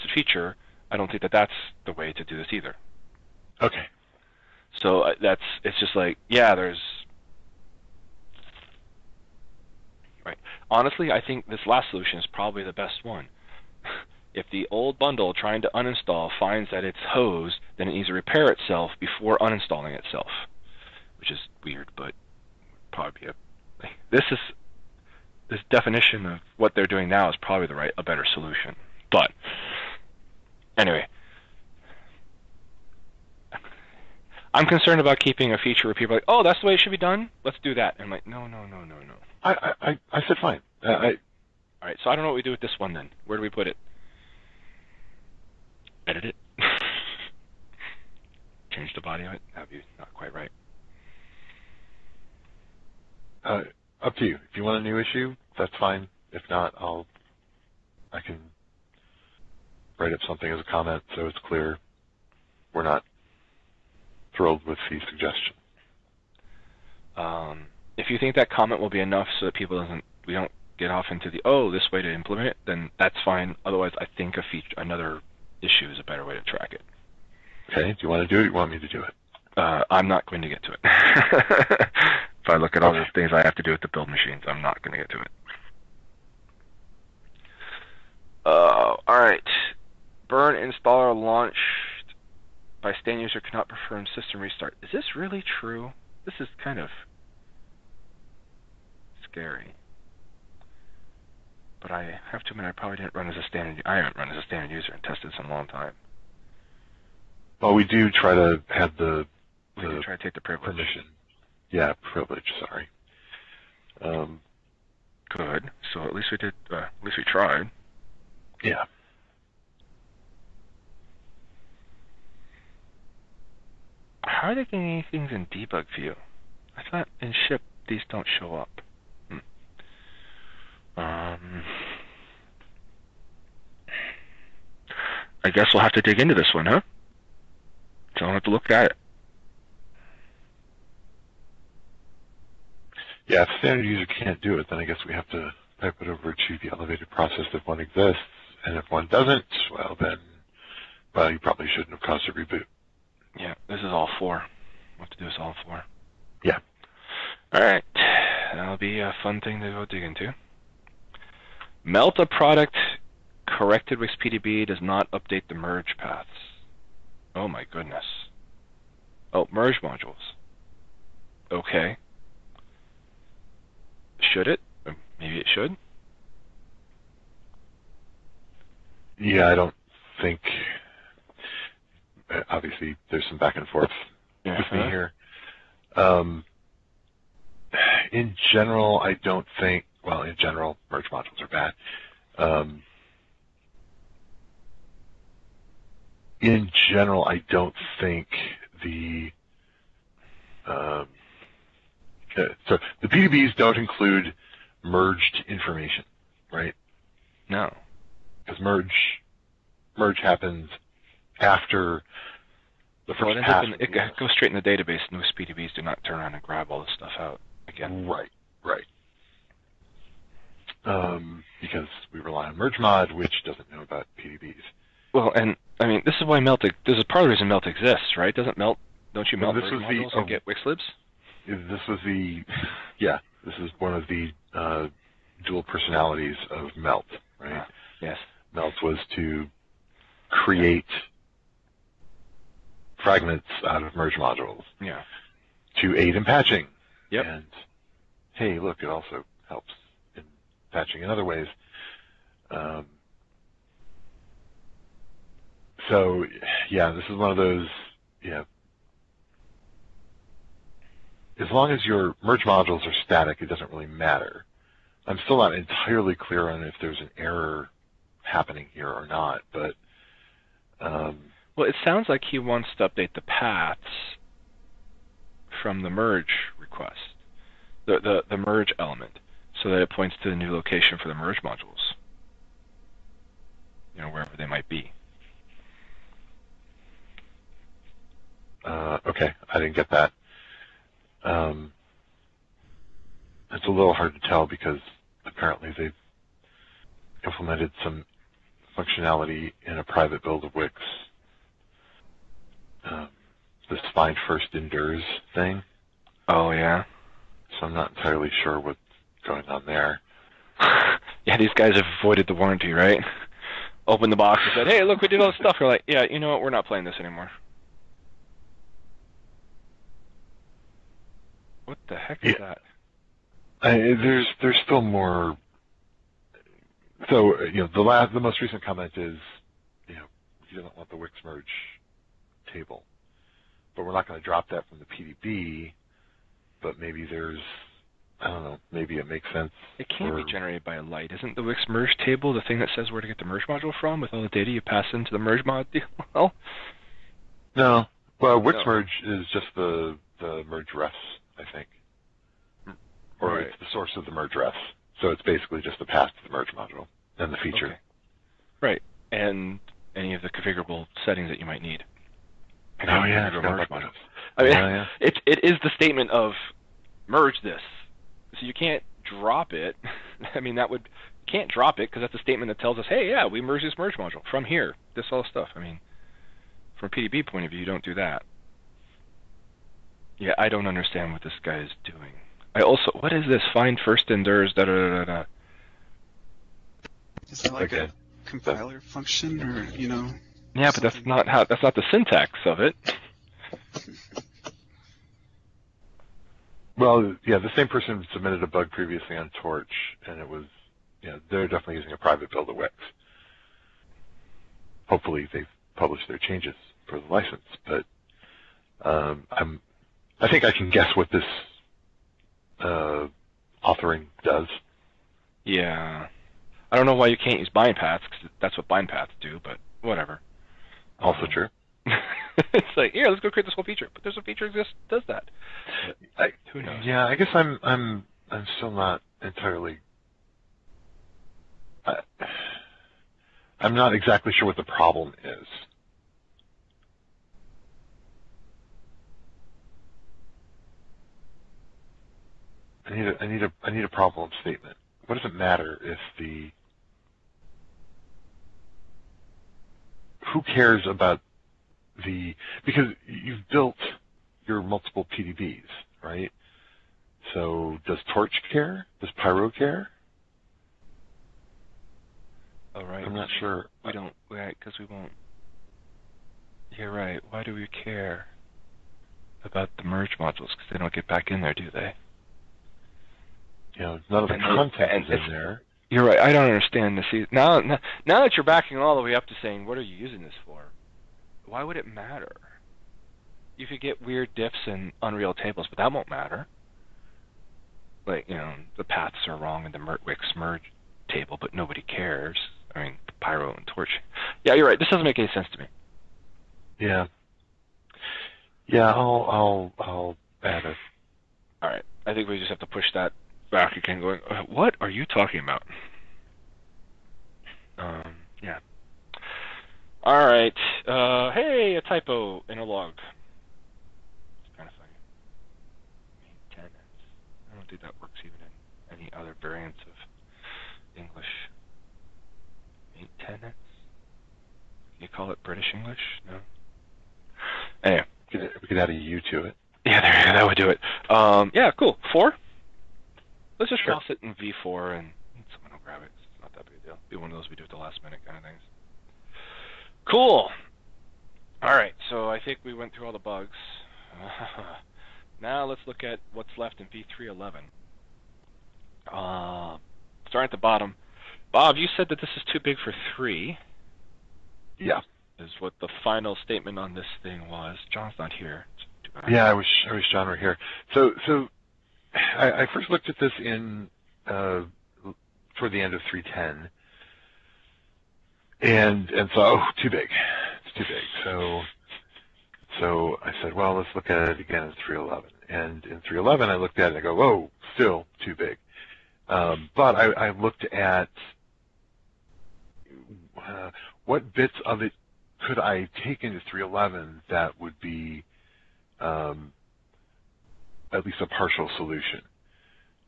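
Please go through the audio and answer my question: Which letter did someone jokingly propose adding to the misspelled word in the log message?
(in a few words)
U.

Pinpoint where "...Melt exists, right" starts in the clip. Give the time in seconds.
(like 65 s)
227 s.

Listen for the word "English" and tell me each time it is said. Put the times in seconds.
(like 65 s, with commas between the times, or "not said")
521 s, 525 s.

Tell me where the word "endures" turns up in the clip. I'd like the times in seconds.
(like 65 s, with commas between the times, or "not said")
304 s, 384 s.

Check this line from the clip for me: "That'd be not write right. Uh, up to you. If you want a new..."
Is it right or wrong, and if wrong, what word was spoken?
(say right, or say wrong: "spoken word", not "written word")
wrong: "quite", not "write".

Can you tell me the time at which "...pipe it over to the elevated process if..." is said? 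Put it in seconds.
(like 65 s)
145 s.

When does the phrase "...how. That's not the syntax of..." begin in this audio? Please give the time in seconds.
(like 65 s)
391 s.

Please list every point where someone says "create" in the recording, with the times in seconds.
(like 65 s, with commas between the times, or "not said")
240 s, 423 s.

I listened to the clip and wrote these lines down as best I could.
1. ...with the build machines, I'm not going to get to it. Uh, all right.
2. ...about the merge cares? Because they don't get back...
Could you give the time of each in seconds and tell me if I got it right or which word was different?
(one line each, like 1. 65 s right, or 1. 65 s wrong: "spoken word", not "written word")
1. 83 s right
2. 469 s wrong: "modules", not "cares".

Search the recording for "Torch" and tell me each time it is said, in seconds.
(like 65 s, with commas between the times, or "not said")
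399 s, 458 s, 493 s.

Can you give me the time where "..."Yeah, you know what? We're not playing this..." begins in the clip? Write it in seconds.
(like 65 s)
315 s.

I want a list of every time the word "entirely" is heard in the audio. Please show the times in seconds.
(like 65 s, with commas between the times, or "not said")
265 s, 307 s, 429 s.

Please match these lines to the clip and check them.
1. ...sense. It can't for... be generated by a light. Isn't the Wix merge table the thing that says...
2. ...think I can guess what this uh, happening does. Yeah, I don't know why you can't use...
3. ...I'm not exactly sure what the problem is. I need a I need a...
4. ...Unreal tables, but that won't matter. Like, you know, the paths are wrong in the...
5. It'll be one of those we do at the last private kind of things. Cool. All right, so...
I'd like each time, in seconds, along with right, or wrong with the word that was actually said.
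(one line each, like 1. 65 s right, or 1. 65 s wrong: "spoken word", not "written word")
1. 339 s right
2. 410 s wrong: "authoring", not "happening"
3. 433 s right
4. 485 s right
5. 537 s wrong: "minute", not "private".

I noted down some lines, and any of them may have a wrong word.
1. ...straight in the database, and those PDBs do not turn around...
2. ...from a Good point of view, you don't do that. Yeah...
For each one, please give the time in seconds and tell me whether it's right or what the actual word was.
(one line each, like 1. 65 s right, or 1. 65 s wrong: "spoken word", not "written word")
1. 214 s right
2. 376 s wrong: "PDB", not "Good".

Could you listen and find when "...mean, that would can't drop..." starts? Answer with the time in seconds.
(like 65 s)
370 s.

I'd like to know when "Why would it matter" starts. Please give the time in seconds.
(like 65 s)
481 s.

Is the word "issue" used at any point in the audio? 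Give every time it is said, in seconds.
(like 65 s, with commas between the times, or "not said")
54 s, 75 s.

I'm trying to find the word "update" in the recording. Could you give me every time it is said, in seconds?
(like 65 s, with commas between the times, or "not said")
165 s, 272 s.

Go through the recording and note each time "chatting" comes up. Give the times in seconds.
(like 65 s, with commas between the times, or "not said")
not said.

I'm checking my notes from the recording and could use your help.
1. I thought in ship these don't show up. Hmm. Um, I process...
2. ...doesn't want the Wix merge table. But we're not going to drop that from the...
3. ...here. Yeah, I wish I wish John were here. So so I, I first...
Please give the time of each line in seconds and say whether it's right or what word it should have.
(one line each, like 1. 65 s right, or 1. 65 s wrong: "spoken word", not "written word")
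1. 126 s wrong: "guess", not "process"
2. 330 s right
3. 558 s right.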